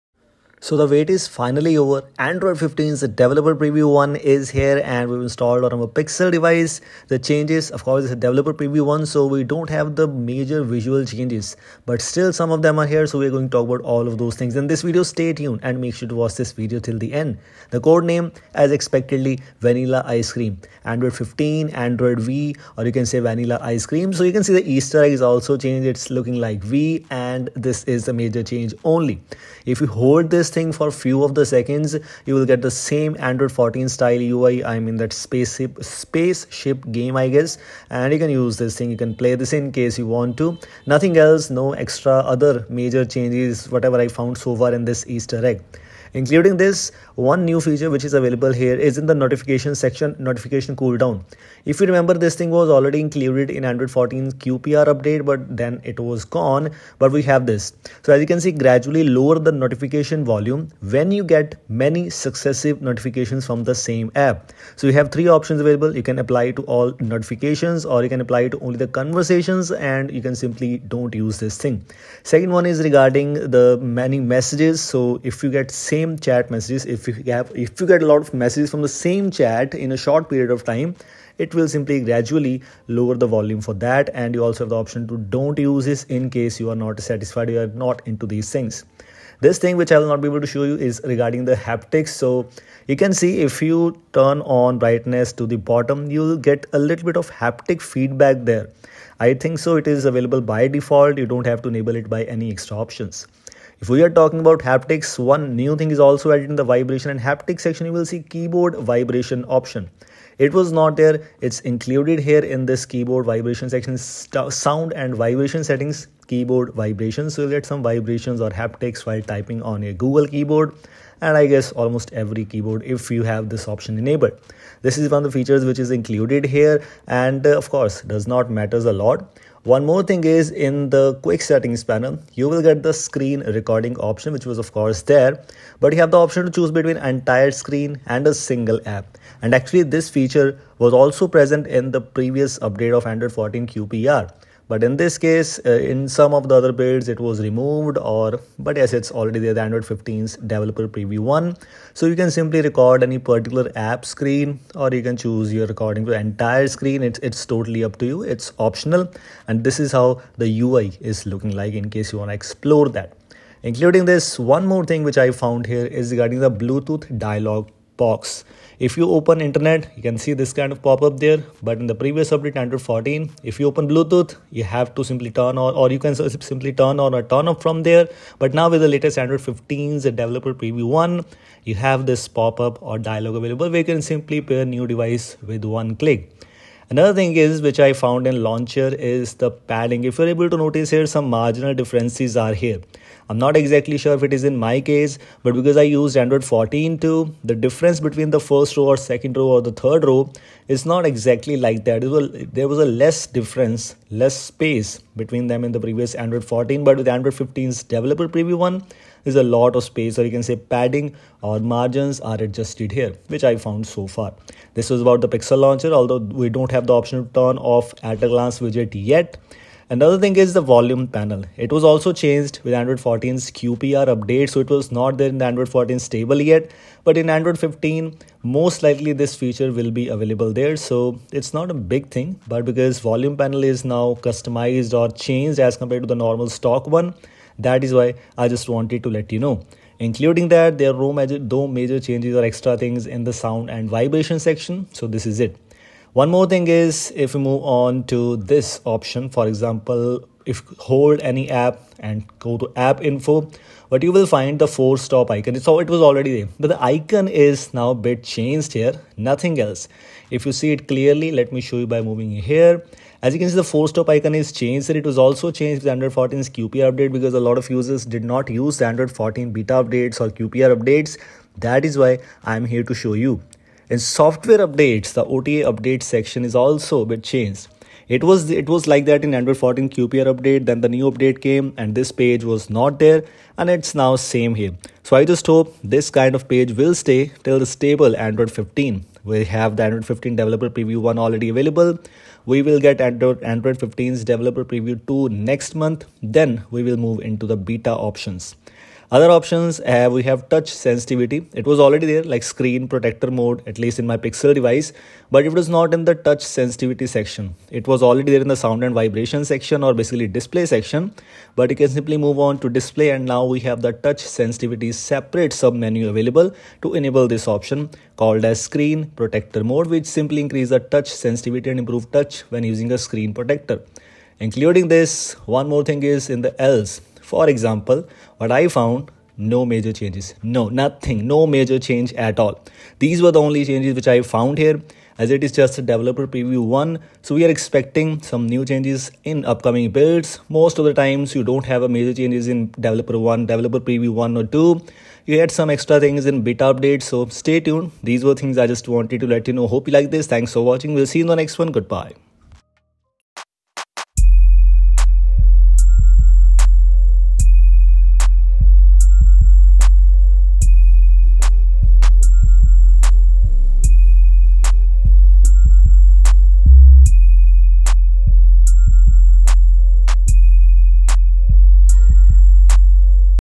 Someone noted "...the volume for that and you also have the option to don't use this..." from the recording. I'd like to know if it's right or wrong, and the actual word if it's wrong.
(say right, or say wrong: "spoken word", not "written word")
right.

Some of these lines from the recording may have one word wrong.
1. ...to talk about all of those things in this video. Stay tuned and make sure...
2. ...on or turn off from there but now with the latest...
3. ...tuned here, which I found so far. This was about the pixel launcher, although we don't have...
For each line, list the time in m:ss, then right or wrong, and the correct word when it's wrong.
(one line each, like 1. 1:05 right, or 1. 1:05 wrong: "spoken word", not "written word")
1. 0:13 right
2. 2:57 right
3. 3:32 wrong: "adjusted", not "tuned".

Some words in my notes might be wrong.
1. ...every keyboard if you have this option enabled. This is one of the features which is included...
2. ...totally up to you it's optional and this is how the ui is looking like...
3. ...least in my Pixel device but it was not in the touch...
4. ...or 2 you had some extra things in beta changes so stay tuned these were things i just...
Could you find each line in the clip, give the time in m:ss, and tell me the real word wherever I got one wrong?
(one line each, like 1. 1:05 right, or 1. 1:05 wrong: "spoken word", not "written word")
1. 2:02 right
2. 2:37 right
3. 5:03 right
4. 5:44 wrong: "updates", not "changes".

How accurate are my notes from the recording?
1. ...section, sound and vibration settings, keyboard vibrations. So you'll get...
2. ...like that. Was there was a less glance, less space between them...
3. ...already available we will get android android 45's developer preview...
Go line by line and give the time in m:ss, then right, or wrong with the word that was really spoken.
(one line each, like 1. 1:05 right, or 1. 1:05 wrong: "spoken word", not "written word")
1. 1:53 right
2. 3:21 wrong: "difference", not "glance"
3. 4:51 wrong: "15", not "45".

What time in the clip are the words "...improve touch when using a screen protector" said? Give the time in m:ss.
5:21.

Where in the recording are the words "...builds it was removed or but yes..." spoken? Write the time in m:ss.
2:26.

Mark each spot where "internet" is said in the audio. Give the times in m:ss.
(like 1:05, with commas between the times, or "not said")
2:49.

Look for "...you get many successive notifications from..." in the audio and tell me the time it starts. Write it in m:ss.
1:01.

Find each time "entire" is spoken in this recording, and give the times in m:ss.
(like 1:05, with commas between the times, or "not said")
2:16, 2:36.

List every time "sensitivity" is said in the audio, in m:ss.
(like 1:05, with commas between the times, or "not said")
5:00, 5:06, 5:14, 5:21.